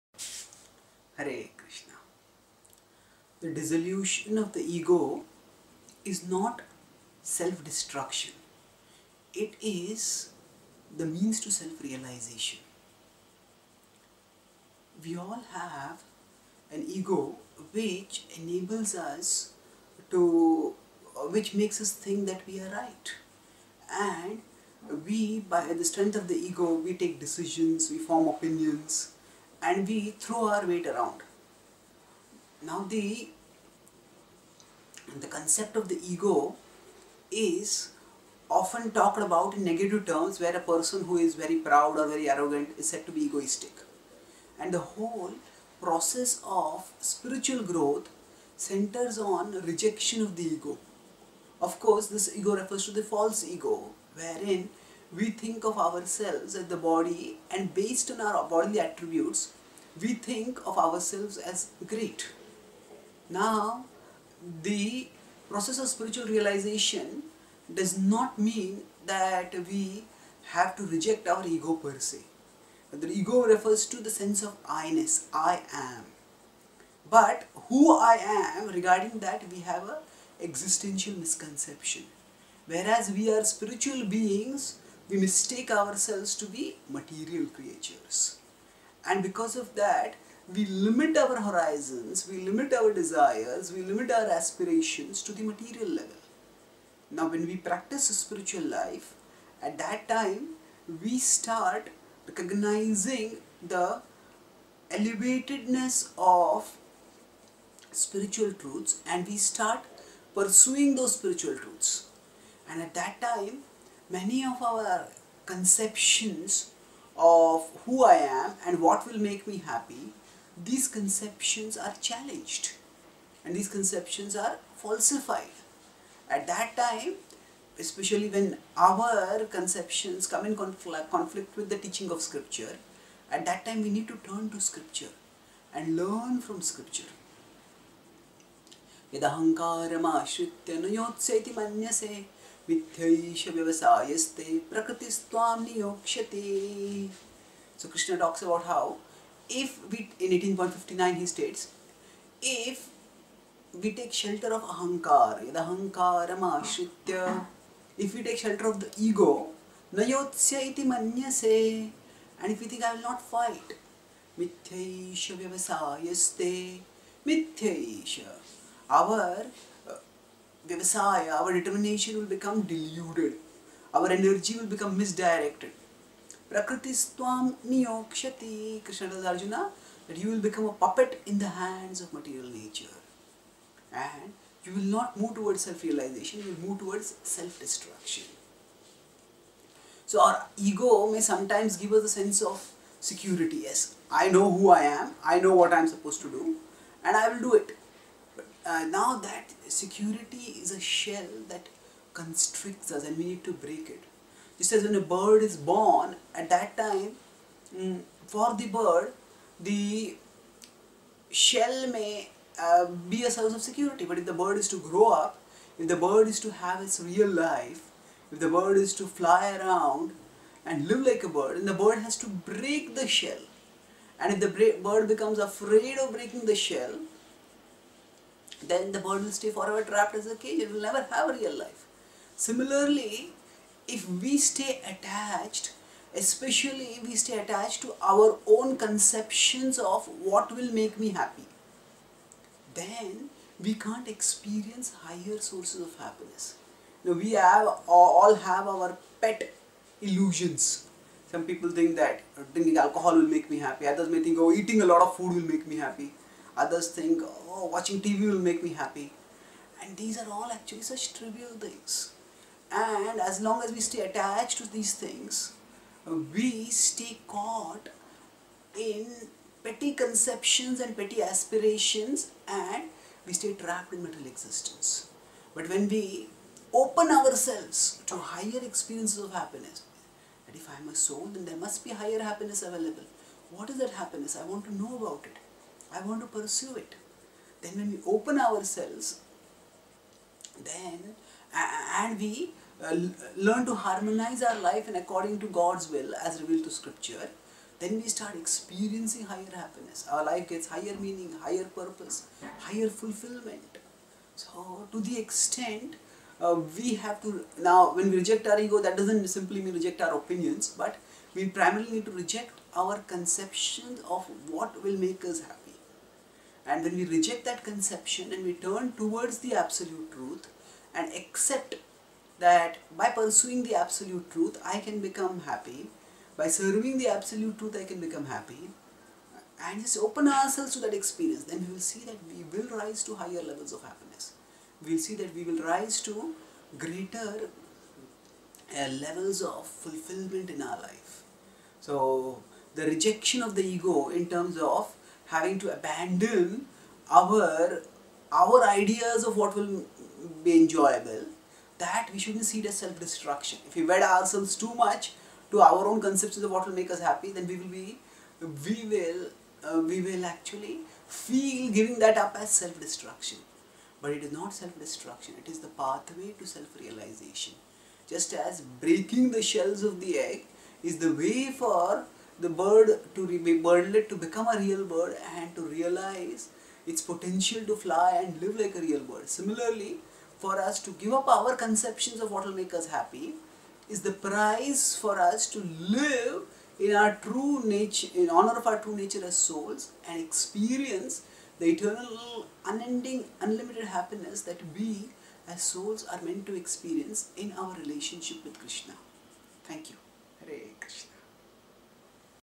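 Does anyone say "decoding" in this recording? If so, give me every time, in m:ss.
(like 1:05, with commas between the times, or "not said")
not said.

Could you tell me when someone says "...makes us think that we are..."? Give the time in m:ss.
0:21.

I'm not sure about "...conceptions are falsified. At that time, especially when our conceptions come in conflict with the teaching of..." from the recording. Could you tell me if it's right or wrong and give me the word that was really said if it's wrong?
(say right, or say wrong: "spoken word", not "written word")
right.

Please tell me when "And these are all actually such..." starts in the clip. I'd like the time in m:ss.
4:19.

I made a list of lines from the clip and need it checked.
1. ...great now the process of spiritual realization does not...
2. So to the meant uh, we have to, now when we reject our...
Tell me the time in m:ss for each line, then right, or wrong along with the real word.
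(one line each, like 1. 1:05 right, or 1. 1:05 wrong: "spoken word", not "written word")
1. 1:01 right
2. 5:04 wrong: "extent", not "meant".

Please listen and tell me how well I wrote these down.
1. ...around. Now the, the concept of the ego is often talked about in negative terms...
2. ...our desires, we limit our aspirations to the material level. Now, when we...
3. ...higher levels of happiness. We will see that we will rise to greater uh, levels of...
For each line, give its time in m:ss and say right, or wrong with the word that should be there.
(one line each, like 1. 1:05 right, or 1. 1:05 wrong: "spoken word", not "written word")
1. 0:30 right
2. 1:32 right
3. 5:33 right.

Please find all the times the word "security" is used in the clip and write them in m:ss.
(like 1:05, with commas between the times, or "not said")
3:12, 3:19, 3:33.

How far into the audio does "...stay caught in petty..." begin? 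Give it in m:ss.
4:26.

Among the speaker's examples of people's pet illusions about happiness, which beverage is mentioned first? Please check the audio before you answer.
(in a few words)
alcohol.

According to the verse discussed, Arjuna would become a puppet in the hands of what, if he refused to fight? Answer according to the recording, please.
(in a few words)
material nature.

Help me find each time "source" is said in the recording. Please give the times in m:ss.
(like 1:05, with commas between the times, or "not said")
3:33, 4:05.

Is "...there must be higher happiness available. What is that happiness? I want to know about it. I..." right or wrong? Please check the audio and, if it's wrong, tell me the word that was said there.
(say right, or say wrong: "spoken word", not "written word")
right.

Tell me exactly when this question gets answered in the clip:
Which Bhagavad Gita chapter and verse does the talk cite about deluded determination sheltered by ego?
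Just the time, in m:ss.
2:30.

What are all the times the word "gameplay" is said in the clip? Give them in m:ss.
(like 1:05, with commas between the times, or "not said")
not said.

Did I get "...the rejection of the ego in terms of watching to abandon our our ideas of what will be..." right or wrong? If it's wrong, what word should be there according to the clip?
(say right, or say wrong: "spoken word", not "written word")
wrong: "having", not "watching".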